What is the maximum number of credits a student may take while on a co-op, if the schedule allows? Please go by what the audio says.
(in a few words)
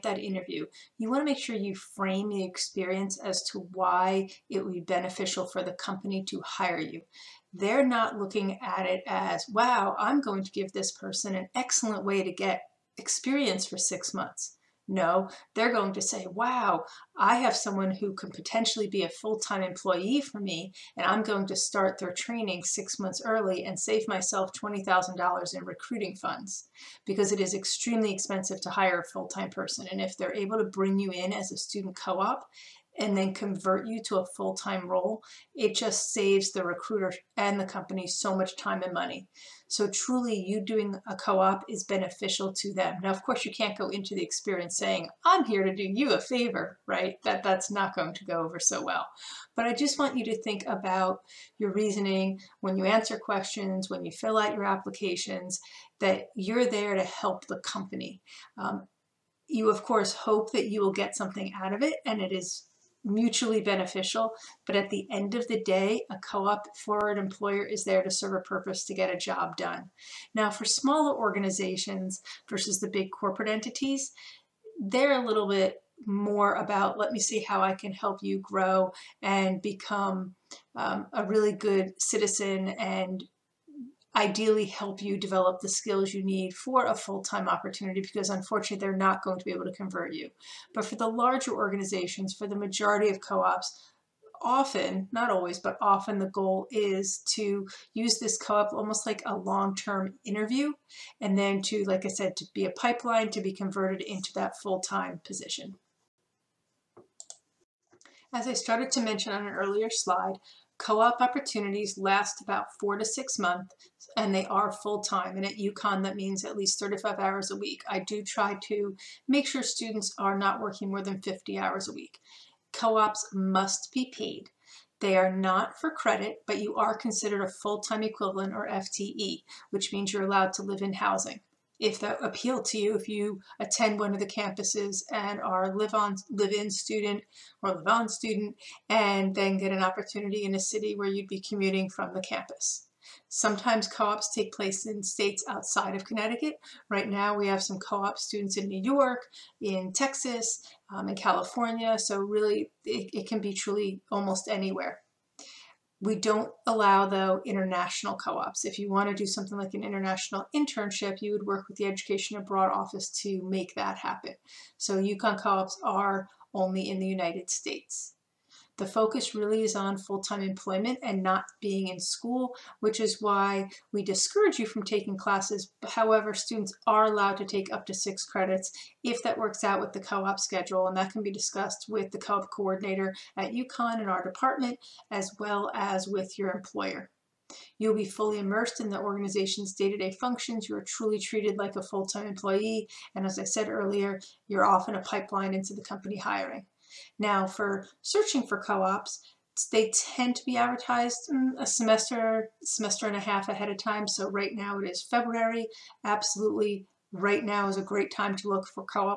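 6 credits.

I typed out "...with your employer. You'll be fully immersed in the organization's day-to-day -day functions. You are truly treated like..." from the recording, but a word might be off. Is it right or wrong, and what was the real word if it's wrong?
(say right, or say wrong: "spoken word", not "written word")
right.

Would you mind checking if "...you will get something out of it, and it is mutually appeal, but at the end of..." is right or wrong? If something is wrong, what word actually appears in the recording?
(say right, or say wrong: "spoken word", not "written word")
wrong: "beneficial", not "appeal".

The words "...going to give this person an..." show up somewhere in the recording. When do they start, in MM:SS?
00:10.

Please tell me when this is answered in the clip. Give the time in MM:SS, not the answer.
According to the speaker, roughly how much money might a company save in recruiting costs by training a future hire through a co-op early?
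00:24.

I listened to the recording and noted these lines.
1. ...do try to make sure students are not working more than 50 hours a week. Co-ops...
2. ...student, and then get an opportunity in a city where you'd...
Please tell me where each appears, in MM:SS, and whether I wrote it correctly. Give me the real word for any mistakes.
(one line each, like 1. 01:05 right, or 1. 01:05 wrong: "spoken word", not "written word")
1. 01:57 right
2. 02:18 right.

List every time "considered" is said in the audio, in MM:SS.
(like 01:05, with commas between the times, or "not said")
02:06.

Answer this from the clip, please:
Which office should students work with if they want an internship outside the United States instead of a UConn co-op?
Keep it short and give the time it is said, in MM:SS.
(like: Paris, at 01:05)
Education Abroad Office, at 02:41.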